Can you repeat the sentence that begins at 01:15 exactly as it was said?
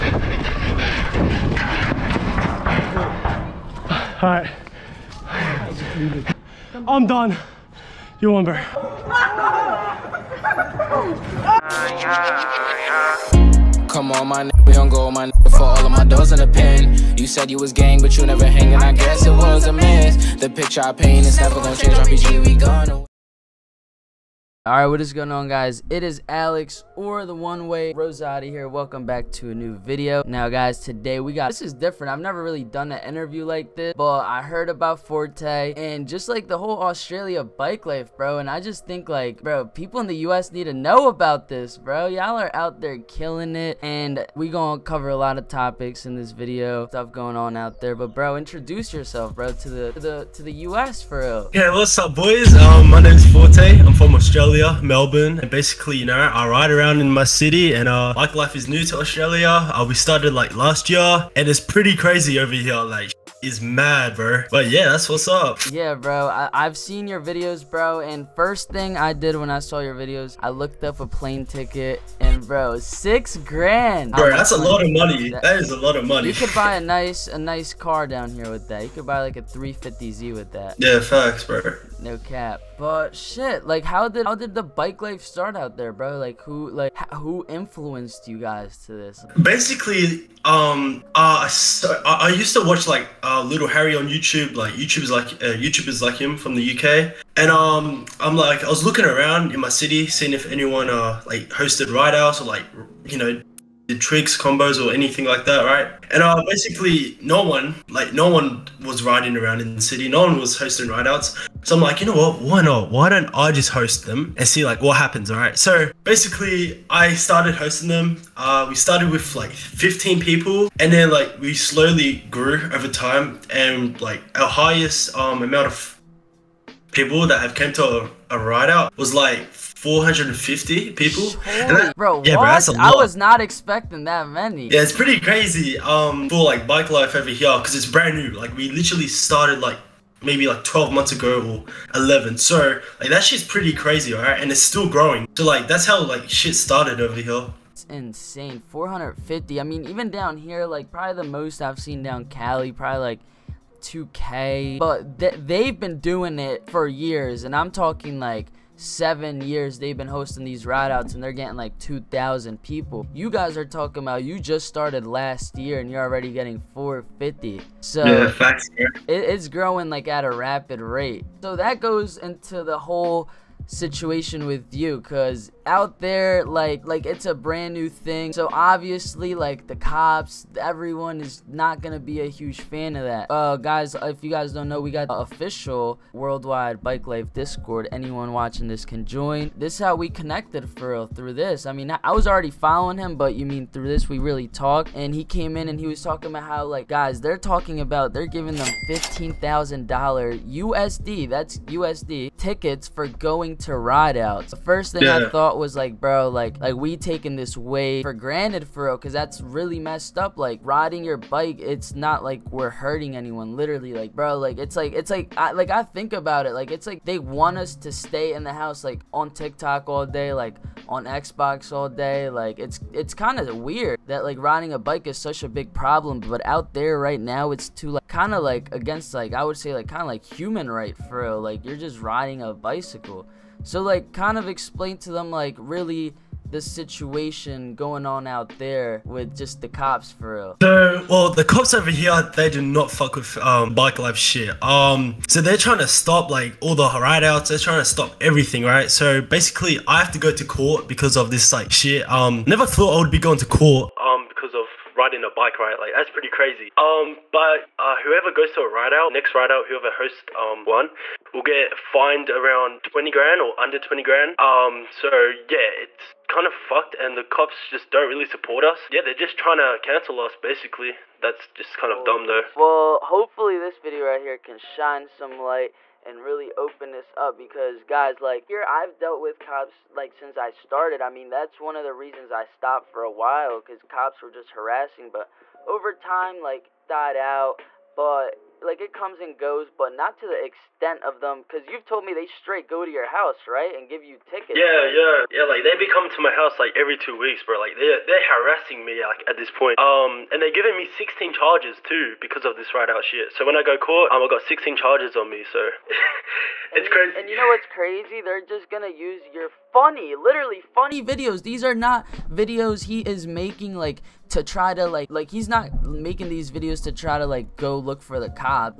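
That, that is a lot of money.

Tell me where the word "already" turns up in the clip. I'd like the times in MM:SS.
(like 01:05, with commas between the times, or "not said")
02:46, 03:12.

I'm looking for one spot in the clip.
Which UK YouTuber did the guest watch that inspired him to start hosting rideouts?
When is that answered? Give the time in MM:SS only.
01:33.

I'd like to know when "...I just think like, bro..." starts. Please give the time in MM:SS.
00:38.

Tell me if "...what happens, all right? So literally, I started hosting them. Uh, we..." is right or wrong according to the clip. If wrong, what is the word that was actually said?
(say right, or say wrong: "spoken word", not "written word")
wrong: "basically", not "literally".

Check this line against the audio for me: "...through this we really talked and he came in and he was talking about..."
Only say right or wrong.
right.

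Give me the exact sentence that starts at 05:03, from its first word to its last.
So when I go court, um, I got 16 charges on me.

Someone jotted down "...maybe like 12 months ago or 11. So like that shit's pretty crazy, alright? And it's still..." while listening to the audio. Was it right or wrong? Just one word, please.
right.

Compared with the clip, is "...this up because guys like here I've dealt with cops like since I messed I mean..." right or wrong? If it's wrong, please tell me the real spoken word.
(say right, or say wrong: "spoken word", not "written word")
wrong: "started", not "messed".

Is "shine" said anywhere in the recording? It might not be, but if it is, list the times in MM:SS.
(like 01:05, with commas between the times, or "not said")
04:34.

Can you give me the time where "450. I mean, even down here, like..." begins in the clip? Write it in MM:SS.
02:28.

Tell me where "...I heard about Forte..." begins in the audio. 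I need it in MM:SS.
00:34.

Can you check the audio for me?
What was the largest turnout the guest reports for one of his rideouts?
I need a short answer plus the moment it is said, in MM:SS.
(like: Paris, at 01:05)
450 people, at 02:09.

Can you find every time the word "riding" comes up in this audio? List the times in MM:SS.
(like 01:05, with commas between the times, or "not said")
01:49, 03:30, 03:44, 03:51, 04:14.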